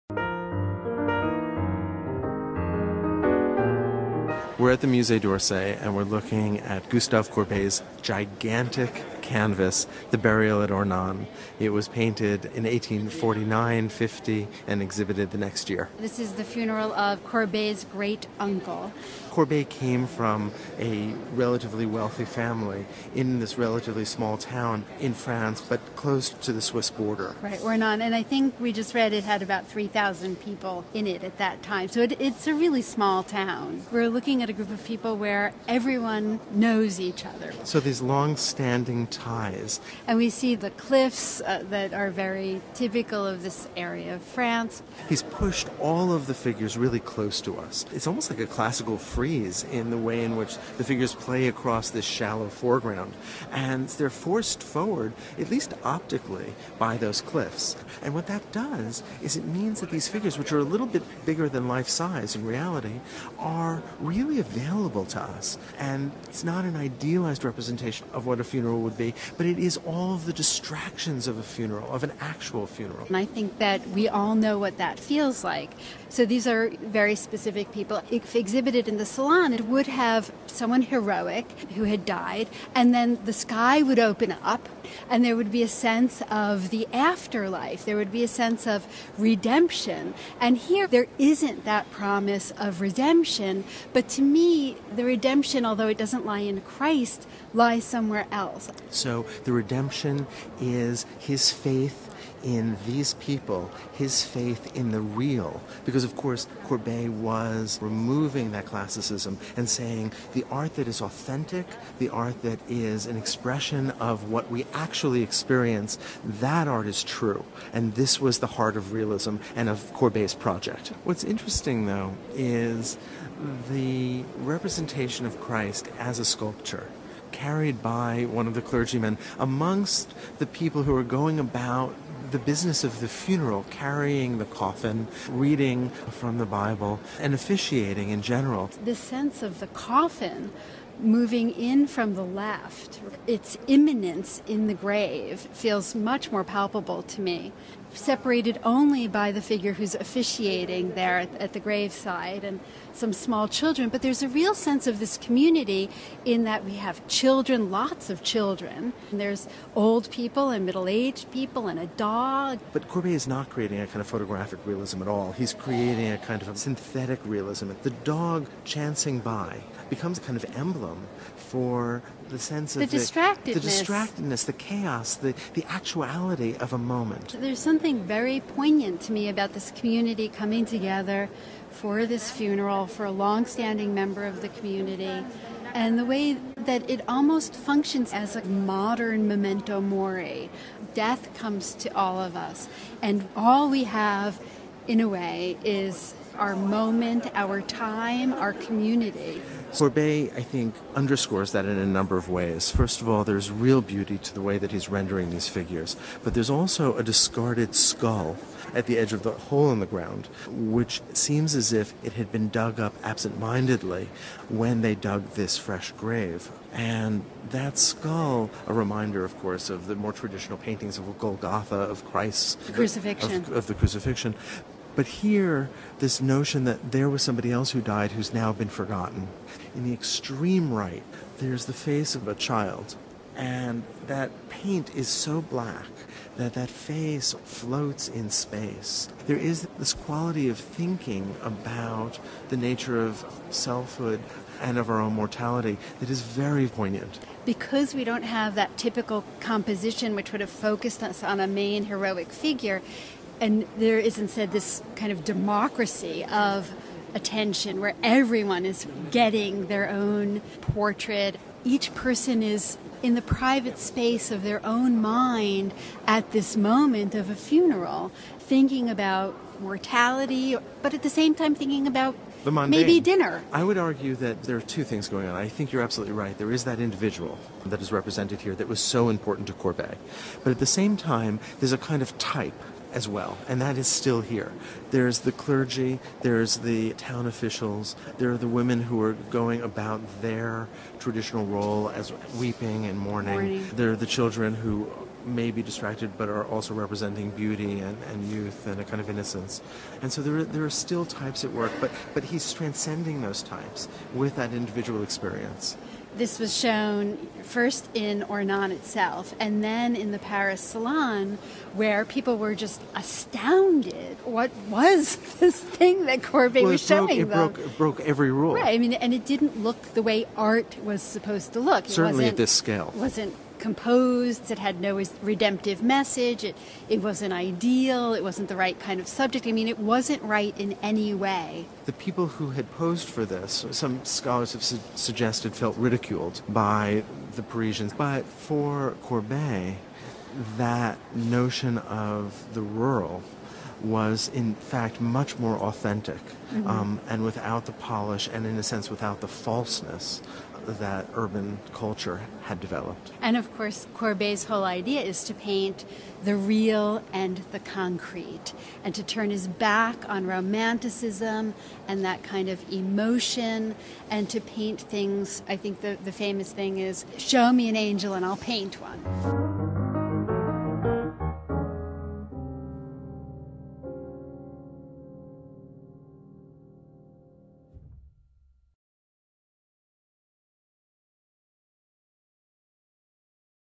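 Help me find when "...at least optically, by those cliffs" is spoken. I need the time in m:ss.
0:55.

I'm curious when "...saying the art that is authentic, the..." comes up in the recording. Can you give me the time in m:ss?
1:49.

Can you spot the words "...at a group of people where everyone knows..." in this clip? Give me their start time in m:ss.
0:34.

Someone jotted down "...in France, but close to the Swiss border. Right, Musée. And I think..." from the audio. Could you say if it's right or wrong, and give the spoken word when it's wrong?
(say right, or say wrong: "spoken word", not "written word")
wrong: "Ornans", not "Musée".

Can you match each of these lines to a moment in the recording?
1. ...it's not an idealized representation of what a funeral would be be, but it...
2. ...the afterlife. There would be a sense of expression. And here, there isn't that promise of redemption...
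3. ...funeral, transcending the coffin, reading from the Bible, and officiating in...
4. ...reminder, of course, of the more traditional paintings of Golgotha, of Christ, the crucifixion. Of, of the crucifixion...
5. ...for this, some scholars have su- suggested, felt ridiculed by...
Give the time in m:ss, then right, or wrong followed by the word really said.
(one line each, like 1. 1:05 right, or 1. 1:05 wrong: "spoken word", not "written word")
1. 1:06 right
2. 1:26 wrong: "redemption", not "expression"
3. 2:13 wrong: "carrying", not "transcending"
4. 3:38 right
5. 5:33 right.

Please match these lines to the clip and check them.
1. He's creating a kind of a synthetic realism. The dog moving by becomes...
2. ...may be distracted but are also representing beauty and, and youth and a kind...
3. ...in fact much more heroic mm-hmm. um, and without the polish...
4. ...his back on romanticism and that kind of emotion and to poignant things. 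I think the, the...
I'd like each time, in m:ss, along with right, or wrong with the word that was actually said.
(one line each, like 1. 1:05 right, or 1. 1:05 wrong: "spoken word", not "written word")
1. 2:45 wrong: "chancing", not "moving"
2. 4:55 right
3. 5:44 wrong: "authentic", not "heroic"
4. 5:59 wrong: "paint", not "poignant".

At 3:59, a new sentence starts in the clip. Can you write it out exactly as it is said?
There is this quality of thinking about the nature of selfhood and of our own mortality that is very poignant.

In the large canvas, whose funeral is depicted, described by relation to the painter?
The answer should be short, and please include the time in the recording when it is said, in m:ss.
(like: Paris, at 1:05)
Courbet's great uncle, at 0:17.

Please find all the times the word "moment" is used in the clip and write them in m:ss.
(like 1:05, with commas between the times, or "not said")
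2:56, 3:16, 4:26.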